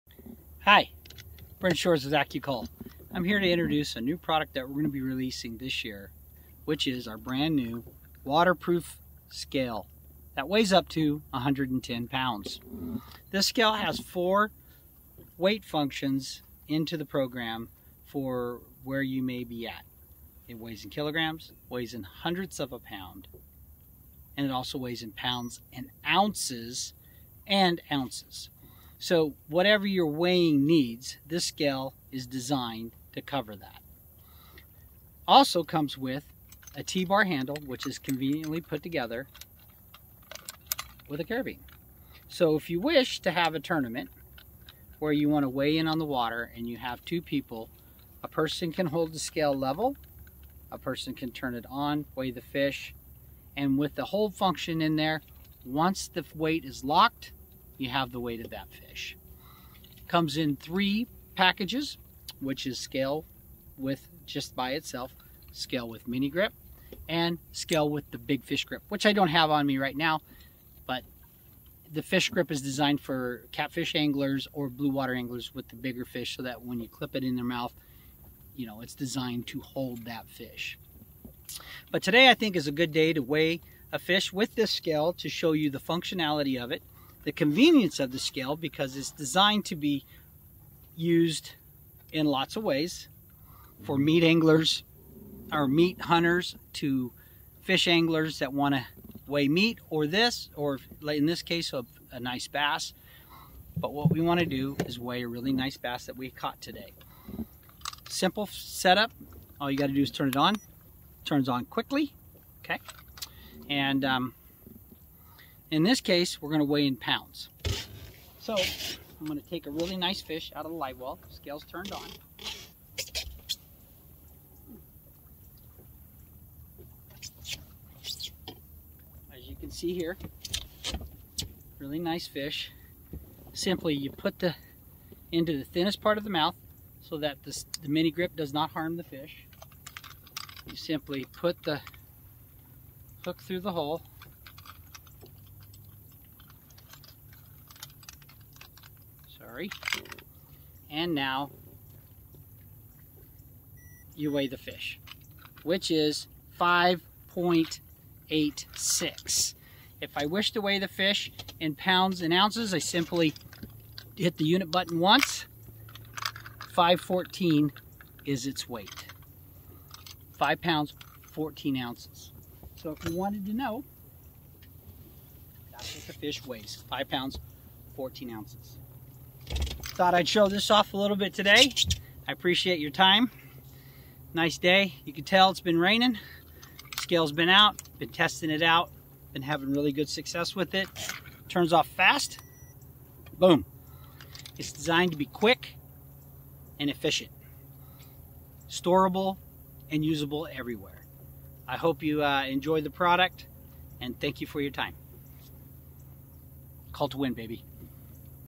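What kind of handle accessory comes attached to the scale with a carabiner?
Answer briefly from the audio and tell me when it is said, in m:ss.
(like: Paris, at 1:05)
T-bar handle, at 0:36.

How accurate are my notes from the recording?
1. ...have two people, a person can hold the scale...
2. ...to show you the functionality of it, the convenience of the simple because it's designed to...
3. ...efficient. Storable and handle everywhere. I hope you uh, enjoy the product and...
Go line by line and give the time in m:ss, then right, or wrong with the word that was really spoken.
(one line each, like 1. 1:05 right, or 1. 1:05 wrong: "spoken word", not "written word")
1. 0:46 right
2. 1:25 wrong: "scale", not "simple"
3. 3:16 wrong: "usable", not "handle".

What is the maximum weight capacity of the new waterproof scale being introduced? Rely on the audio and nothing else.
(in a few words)
110 pounds.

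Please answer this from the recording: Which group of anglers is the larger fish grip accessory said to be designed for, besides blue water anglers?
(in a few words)
catfish anglers.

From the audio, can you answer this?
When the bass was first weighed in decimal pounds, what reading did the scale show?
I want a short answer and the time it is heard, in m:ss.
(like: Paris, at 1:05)
5.86, at 2:36.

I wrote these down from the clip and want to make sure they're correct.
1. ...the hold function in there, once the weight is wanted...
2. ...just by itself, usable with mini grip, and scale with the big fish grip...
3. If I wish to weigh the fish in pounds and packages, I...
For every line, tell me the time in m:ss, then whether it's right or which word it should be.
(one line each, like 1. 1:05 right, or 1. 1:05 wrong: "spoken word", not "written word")
1. 0:53 wrong: "locked", not "wanted"
2. 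1:04 wrong: "scale", not "usable"
3. 2:40 wrong: "ounces", not "packages".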